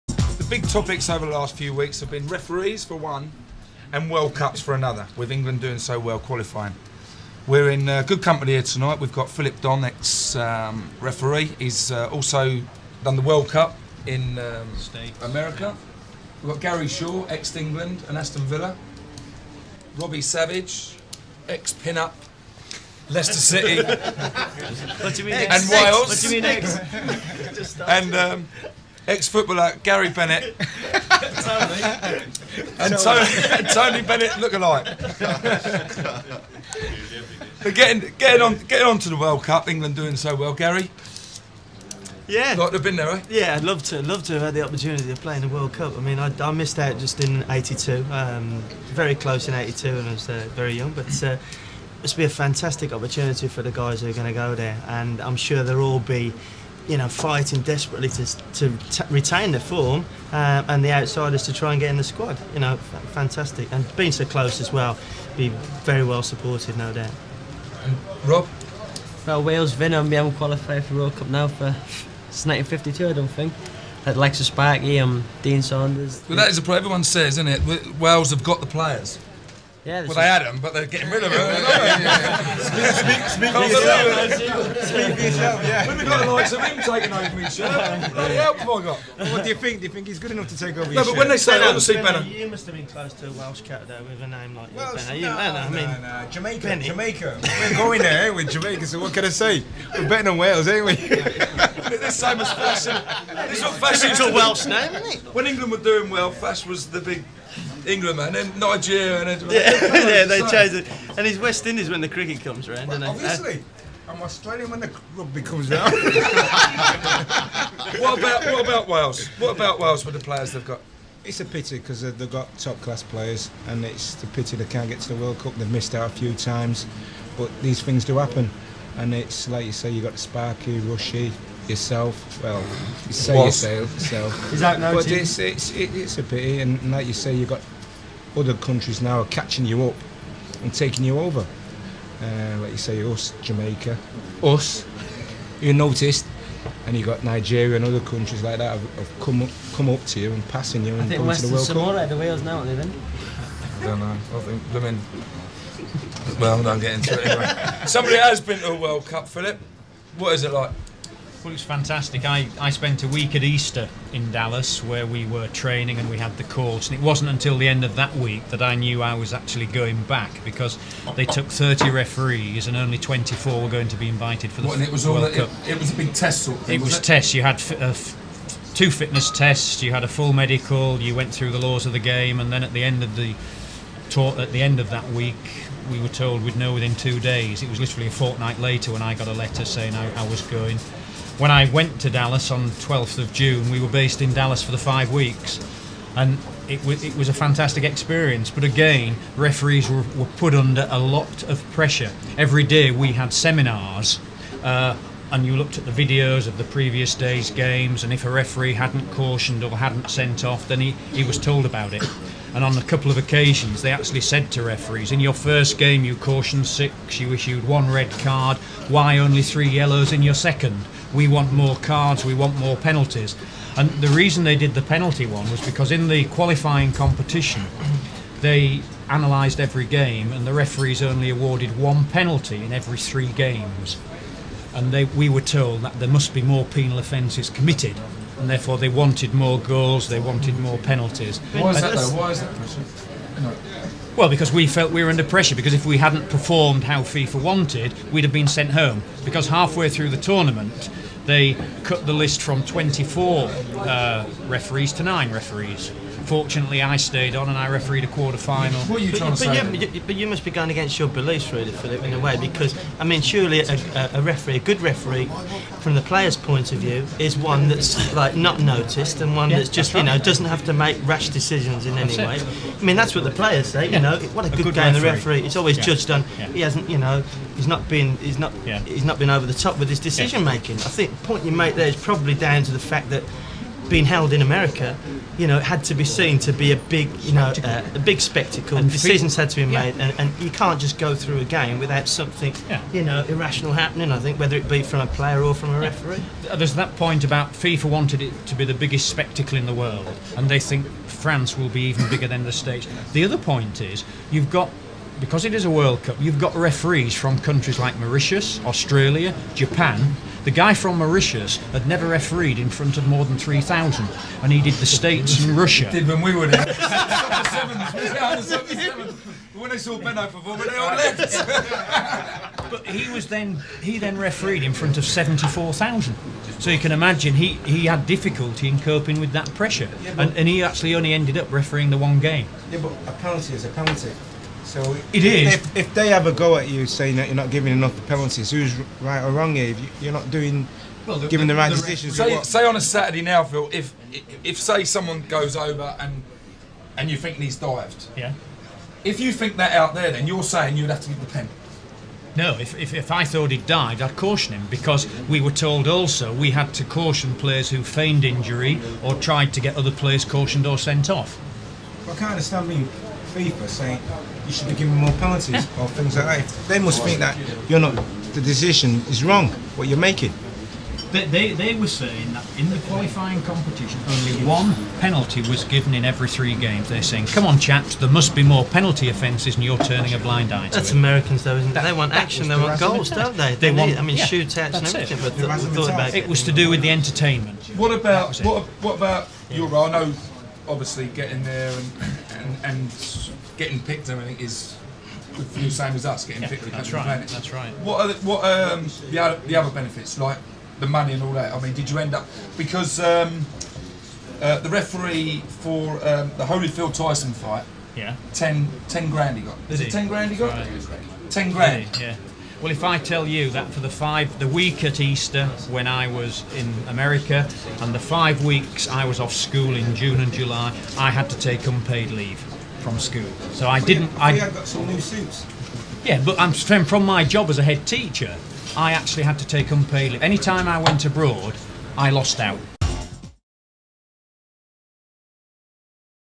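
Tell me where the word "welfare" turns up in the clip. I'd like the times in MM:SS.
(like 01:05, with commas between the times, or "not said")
not said.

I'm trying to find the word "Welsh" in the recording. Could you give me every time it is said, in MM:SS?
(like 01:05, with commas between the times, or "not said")
01:33, 01:44.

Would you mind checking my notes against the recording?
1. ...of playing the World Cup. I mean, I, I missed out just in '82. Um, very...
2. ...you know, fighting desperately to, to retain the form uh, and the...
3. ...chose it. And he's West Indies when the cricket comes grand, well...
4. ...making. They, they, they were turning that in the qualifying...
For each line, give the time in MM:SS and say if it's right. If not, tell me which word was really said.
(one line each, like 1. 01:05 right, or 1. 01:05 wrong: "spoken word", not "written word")
1. 00:45 right
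2. 00:56 right
3. 01:50 wrong: "round", not "grand"
4. 06:09 wrong: "saying", not "turning".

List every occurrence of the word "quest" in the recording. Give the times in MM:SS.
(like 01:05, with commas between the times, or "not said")
not said.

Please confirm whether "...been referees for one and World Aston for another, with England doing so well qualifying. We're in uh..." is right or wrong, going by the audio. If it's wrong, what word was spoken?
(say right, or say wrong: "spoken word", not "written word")
wrong: "Cups", not "Aston".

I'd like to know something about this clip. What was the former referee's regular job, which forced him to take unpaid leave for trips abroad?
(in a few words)
Head teacher.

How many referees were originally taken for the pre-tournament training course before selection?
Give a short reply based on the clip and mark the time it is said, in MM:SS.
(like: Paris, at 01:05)
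30, at 02:51.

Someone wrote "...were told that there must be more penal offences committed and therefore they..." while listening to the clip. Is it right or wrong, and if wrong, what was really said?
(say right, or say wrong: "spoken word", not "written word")
right.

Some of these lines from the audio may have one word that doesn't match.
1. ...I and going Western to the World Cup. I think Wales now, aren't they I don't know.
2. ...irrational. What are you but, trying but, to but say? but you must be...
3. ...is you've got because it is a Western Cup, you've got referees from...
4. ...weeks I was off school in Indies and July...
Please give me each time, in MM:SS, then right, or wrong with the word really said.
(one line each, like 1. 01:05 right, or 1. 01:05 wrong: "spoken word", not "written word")
1. 02:30 right
2. 04:18 wrong: "final", not "irrational"
3. 05:03 wrong: "World", not "Western"
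4. 06:58 wrong: "June", not "Indies".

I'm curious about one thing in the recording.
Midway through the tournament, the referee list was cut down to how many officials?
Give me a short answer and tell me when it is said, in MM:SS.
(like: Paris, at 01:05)
9, at 04:15.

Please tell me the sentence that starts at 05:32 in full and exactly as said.
Yeah, but a penalty is a penalty.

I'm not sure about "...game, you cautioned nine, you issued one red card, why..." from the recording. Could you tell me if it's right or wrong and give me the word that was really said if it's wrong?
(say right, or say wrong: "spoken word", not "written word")
wrong: "six", not "nine".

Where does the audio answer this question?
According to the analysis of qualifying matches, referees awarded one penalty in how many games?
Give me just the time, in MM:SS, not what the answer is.
03:51.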